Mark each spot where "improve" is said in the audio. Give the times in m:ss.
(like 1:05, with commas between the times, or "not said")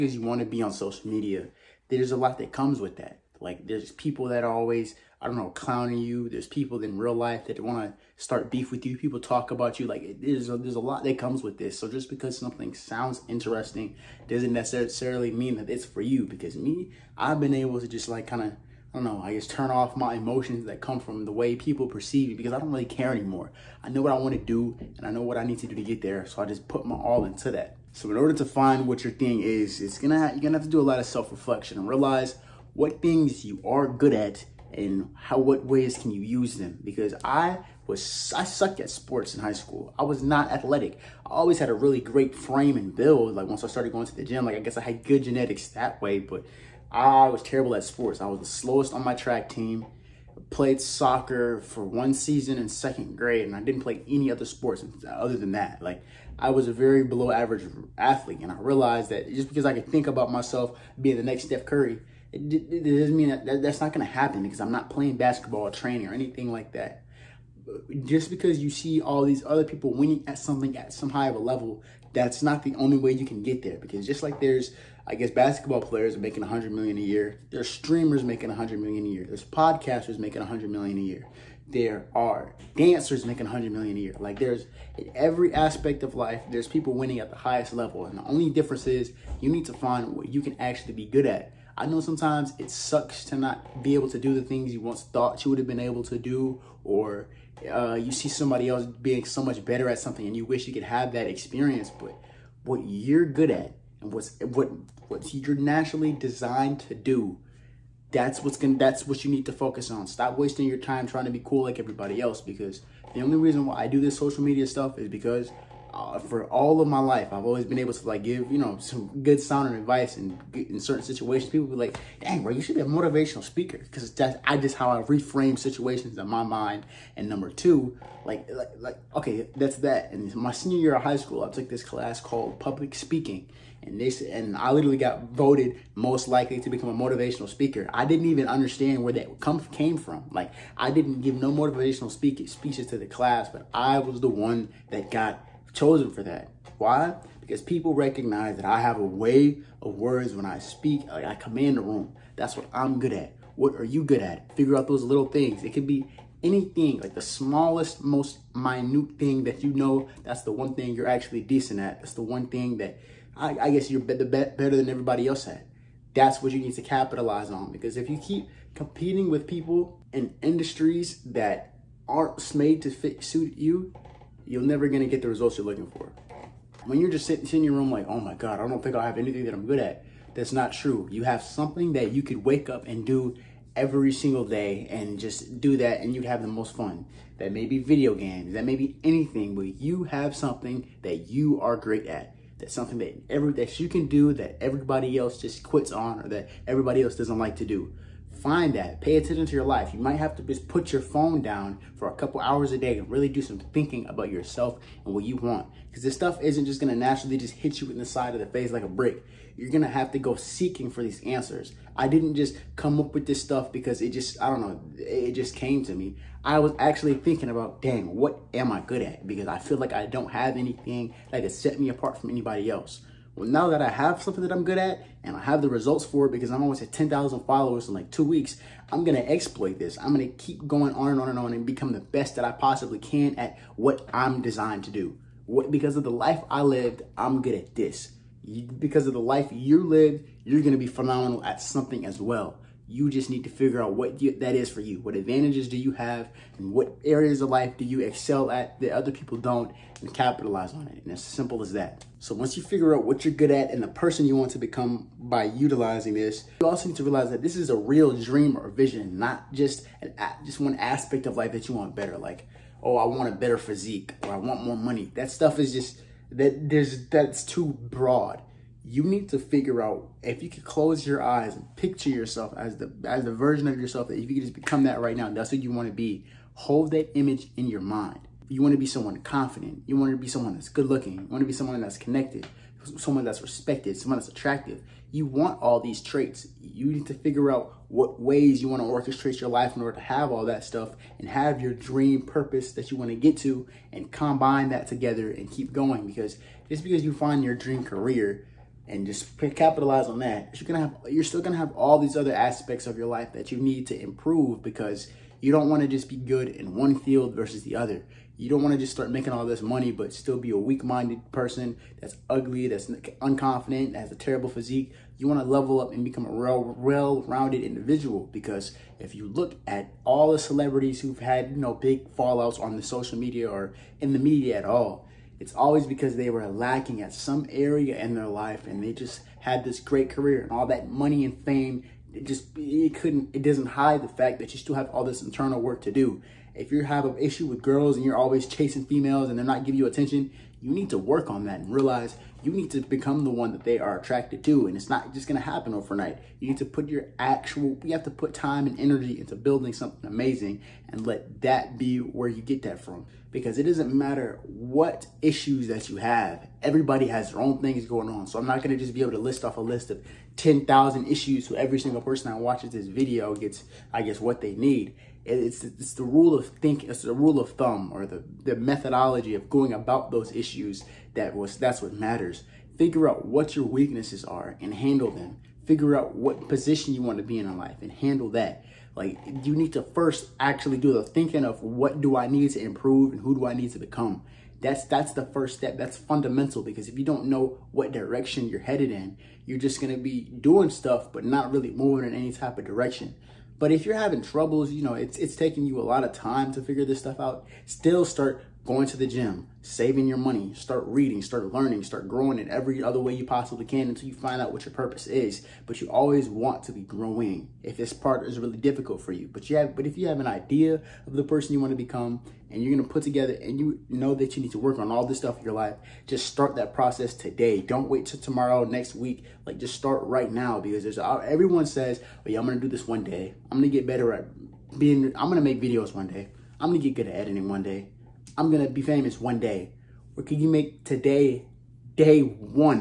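5:04, 6:22.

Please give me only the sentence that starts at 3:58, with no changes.
You, because of the life you lived, you're going to be phenomenal at something as well.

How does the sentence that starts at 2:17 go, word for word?
I didn't even understand where that come came from.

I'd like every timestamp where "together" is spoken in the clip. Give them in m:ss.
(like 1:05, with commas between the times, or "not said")
4:54, 6:53.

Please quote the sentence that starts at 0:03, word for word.
Like there's people that are always, I don't know, clowning you.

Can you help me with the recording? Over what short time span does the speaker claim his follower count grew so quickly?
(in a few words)
two weeks.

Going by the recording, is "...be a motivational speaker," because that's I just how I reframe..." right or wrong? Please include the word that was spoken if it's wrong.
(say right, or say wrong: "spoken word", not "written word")
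right.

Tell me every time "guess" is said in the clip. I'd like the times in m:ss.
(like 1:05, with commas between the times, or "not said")
0:44, 1:15, 2:43, 6:04.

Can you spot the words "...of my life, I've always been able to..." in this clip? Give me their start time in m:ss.
1:56.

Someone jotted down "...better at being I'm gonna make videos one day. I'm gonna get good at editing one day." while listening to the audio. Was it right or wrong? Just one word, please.
right.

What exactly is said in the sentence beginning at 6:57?
Don't wait till tomorrow, next week.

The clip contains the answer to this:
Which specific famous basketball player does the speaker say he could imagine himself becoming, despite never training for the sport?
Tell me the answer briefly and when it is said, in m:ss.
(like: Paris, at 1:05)
Steph Curry, at 1:01.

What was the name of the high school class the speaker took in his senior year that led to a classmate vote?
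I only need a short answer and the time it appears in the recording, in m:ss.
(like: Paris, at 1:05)
public speaking, at 2:12.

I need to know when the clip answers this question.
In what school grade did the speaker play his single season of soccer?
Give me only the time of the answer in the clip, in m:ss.
0:52.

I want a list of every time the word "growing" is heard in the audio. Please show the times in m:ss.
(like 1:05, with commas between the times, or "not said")
6:42, 6:46.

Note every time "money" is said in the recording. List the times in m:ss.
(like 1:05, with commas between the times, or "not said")
4:24, 5:09, 5:30, 6:40.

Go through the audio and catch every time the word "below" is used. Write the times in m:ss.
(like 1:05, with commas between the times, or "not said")
0:57.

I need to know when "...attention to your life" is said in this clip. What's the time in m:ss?
3:19.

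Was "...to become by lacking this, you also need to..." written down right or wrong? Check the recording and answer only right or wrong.
wrong.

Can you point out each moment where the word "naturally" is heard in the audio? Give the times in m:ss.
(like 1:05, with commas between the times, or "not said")
1:45, 3:26.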